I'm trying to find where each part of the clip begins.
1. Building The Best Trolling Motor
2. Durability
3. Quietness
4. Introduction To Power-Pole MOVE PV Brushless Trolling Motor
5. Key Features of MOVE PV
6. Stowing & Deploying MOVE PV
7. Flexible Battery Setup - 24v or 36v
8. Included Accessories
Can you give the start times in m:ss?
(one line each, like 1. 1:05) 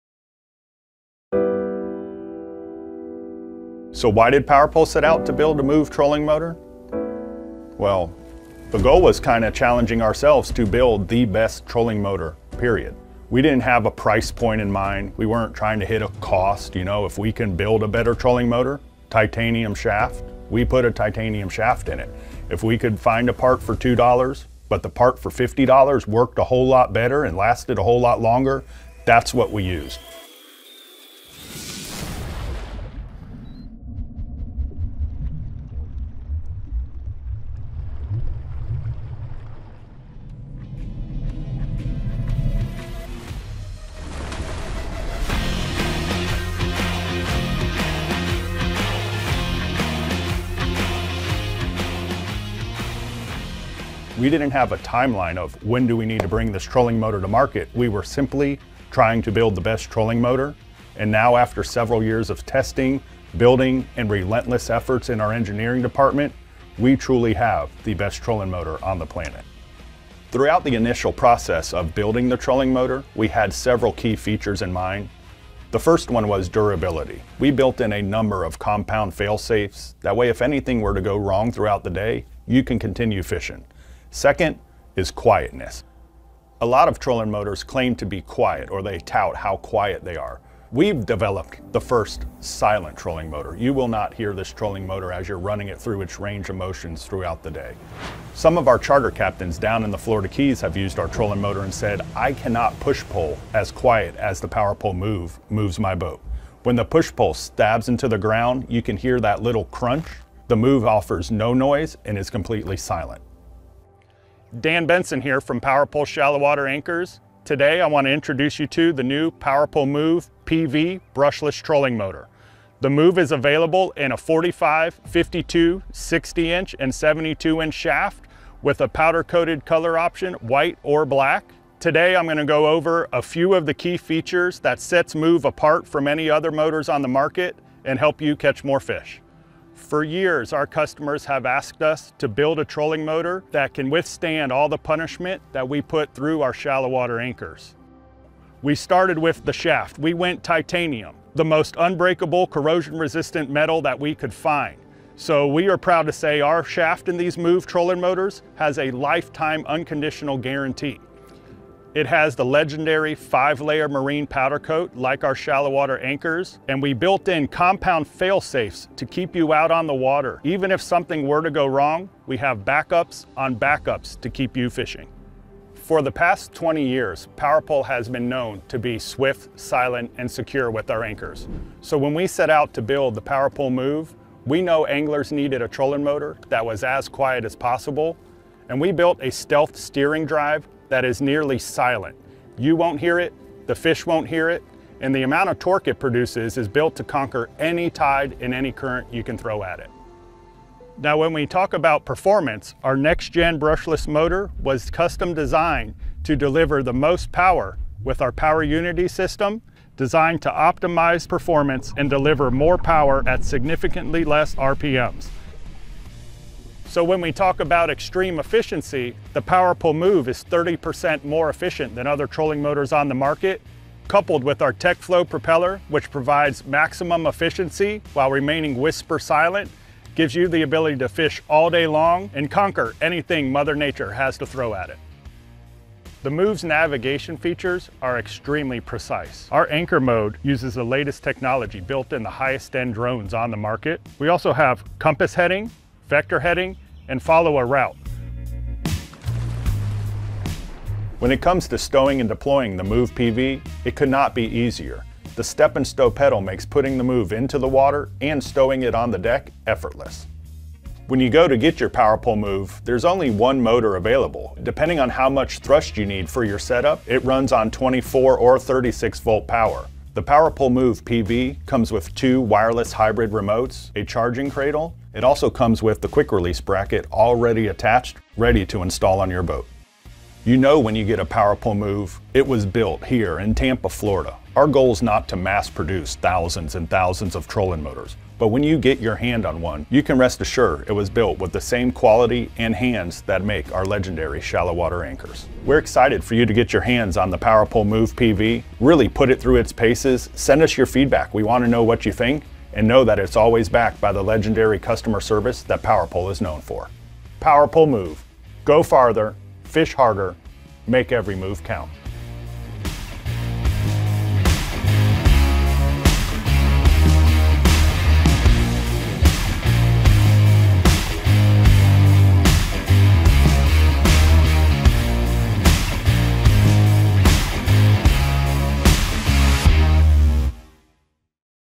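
1. 0:53
2. 1:09
3. 1:23
4. 1:54
5. 2:19
6. 4:09
7. 4:19
8. 4:29.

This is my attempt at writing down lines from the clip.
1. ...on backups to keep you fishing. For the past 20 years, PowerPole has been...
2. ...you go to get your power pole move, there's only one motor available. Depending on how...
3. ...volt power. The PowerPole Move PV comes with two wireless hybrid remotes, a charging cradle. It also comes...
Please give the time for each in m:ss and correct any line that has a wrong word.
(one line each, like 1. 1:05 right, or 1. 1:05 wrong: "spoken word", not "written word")
1. 2:53 right
2. 4:21 right
3. 4:29 right.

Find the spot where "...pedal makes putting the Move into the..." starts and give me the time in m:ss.
4:16.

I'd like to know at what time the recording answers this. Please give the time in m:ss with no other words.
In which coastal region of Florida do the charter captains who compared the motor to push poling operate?
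1:39.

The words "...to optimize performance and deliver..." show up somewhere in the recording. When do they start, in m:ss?
3:30.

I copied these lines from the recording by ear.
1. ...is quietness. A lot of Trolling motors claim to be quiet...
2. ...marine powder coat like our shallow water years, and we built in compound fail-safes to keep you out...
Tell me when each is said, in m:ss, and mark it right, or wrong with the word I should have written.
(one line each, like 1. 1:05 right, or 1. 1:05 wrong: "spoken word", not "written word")
1. 1:24 right
2. 2:43 wrong: "anchors", not "years".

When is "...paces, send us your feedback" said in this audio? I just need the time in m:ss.
4:59.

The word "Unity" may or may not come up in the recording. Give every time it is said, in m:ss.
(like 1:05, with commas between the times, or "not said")
3:28.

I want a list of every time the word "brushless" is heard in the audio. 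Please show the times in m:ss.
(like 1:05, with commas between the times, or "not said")
2:01, 3:23.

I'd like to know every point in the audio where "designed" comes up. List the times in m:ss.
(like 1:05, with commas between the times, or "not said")
3:25, 3:29.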